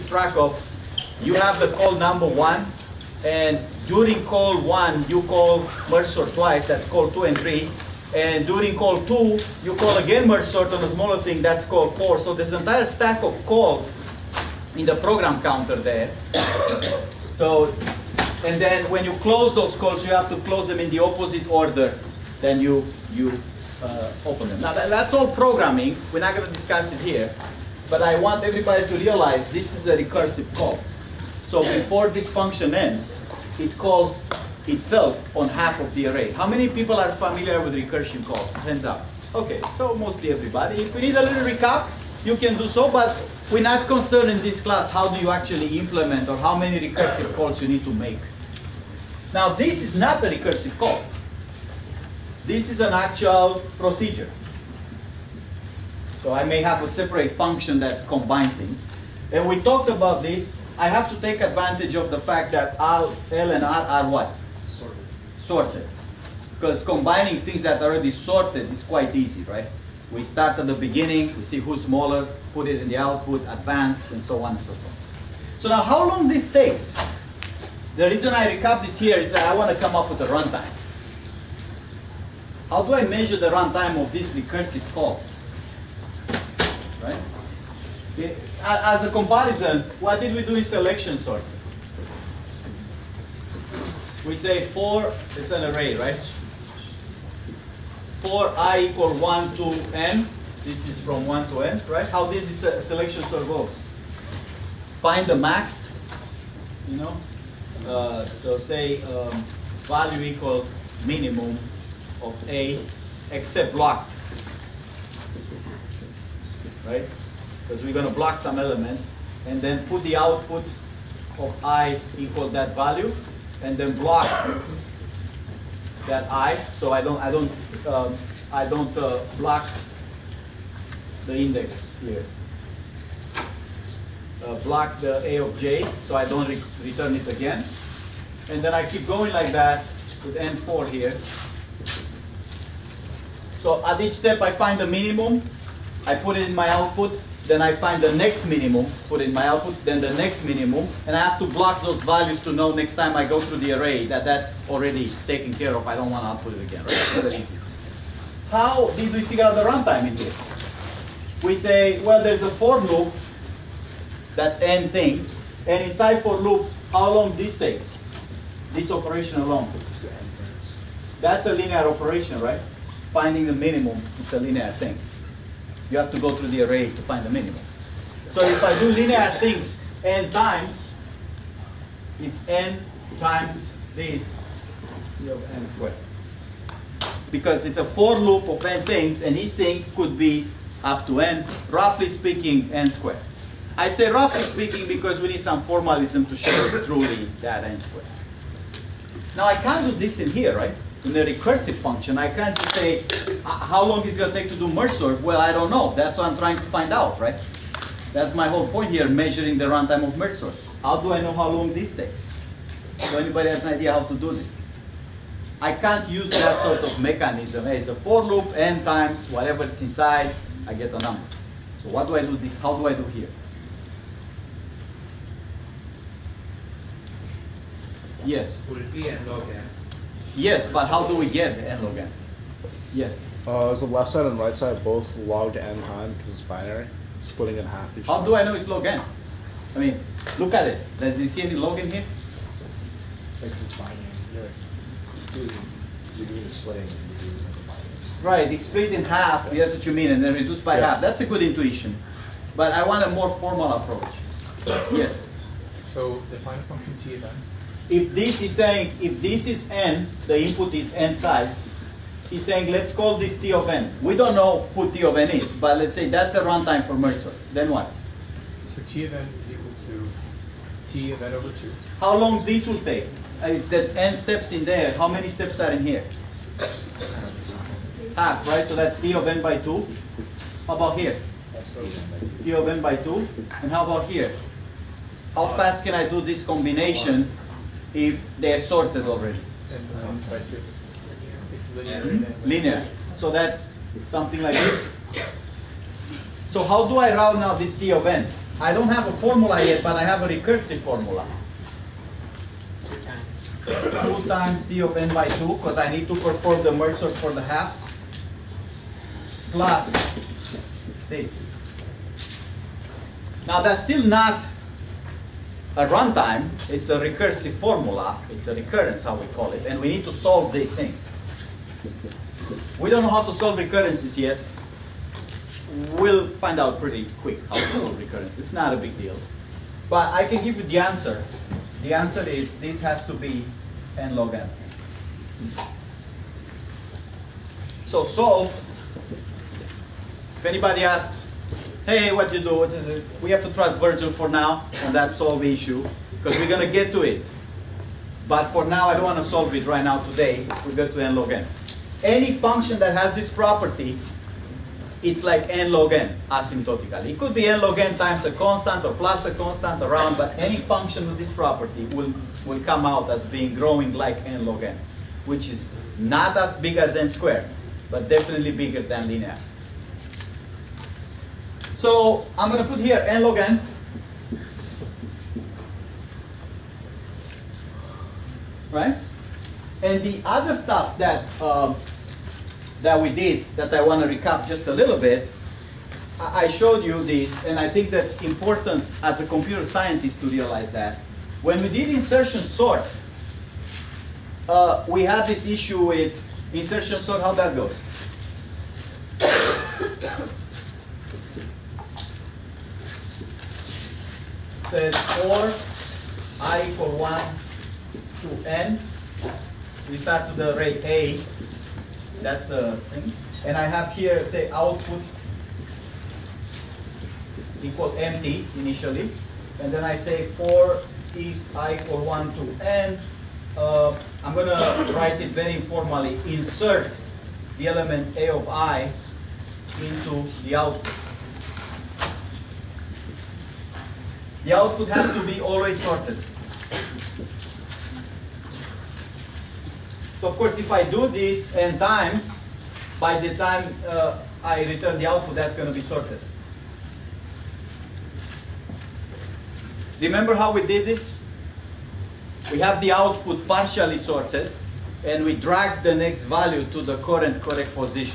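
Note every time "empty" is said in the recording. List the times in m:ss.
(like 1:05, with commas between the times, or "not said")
6:57.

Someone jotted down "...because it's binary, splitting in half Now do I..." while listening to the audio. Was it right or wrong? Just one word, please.
wrong.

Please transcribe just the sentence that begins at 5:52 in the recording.
Any function that has this property, it's like n log n asymptotically.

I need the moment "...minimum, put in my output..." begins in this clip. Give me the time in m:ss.
2:28.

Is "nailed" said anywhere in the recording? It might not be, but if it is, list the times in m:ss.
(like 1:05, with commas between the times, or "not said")
not said.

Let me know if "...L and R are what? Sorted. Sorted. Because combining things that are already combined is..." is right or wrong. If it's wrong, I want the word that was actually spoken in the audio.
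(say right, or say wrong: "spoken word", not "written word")
wrong: "sorted", not "combined".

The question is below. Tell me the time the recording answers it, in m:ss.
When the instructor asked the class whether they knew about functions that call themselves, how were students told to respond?
0:38.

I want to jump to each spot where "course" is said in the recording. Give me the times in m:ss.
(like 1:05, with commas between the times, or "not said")
7:20.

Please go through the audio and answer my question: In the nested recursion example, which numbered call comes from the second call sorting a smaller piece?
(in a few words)
Call four.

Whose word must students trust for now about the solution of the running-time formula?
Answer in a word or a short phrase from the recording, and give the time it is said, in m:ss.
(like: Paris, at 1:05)
Virgil, at 5:43.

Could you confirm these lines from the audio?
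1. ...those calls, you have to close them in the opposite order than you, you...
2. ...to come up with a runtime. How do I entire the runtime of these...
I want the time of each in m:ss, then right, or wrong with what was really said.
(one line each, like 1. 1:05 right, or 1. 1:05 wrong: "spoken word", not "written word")
1. 0:19 right
2. 1:19 wrong: "measure", not "entire".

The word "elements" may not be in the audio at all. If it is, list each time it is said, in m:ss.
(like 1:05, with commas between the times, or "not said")
1:58, 7:07.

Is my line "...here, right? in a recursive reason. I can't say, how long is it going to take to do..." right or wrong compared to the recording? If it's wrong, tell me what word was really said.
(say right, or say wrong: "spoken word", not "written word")
wrong: "function", not "reason".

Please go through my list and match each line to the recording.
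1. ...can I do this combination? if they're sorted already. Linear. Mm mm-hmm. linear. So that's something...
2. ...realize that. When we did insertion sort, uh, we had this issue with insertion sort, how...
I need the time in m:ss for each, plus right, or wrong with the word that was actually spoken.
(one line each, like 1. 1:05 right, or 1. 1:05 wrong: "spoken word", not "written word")
1. 4:45 right
2. 6:30 right.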